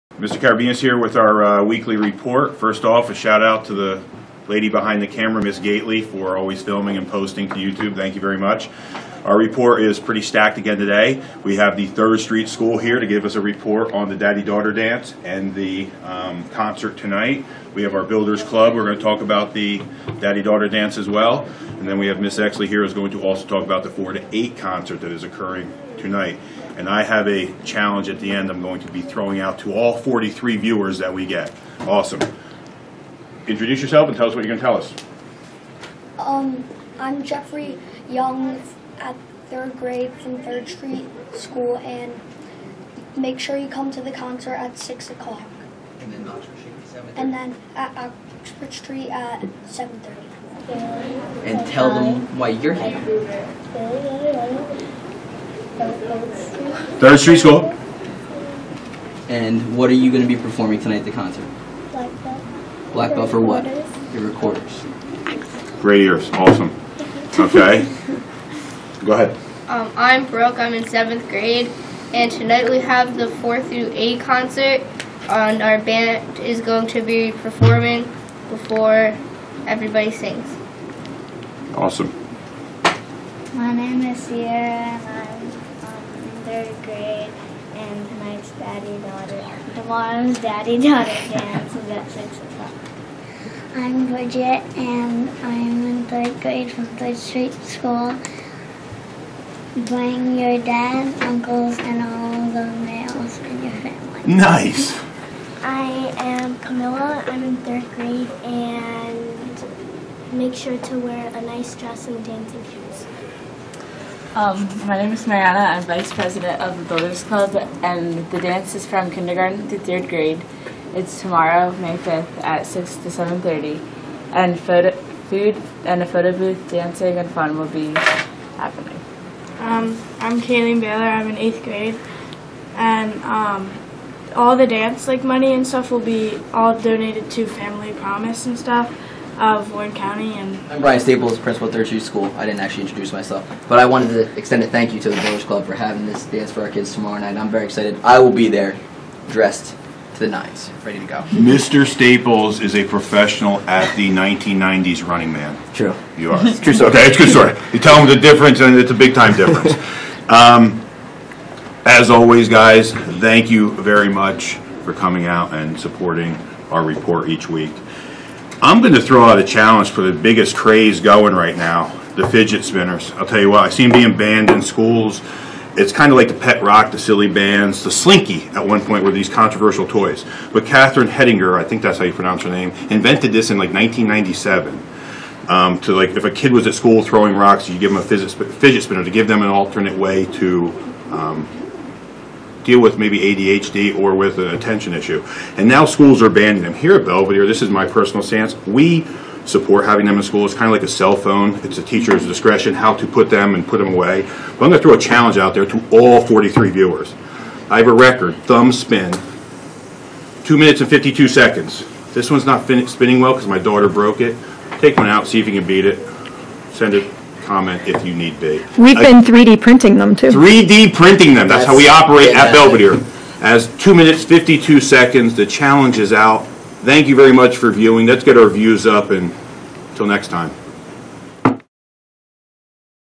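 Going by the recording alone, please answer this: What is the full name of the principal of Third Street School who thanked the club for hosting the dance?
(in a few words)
Brian Staples.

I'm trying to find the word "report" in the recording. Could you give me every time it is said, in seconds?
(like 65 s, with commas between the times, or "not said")
1 s, 9 s, 13 s, 166 s.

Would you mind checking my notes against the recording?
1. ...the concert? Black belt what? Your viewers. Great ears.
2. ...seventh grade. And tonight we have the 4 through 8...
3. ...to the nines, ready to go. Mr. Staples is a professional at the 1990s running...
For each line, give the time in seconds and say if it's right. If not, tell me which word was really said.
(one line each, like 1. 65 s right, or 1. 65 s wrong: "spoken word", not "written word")
1. 61 s wrong: "recorders", not "viewers"
2. 70 s right
3. 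150 s right.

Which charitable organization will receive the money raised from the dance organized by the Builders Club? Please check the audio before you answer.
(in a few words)
Family Promise.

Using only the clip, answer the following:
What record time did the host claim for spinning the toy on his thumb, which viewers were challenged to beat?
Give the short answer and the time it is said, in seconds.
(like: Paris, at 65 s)
2 minutes 52 seconds, at 210 s.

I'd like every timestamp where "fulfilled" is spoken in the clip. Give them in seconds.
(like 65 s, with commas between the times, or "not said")
not said.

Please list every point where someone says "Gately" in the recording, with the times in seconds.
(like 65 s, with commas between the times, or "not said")
5 s.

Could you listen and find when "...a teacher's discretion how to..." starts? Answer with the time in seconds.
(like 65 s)
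201 s.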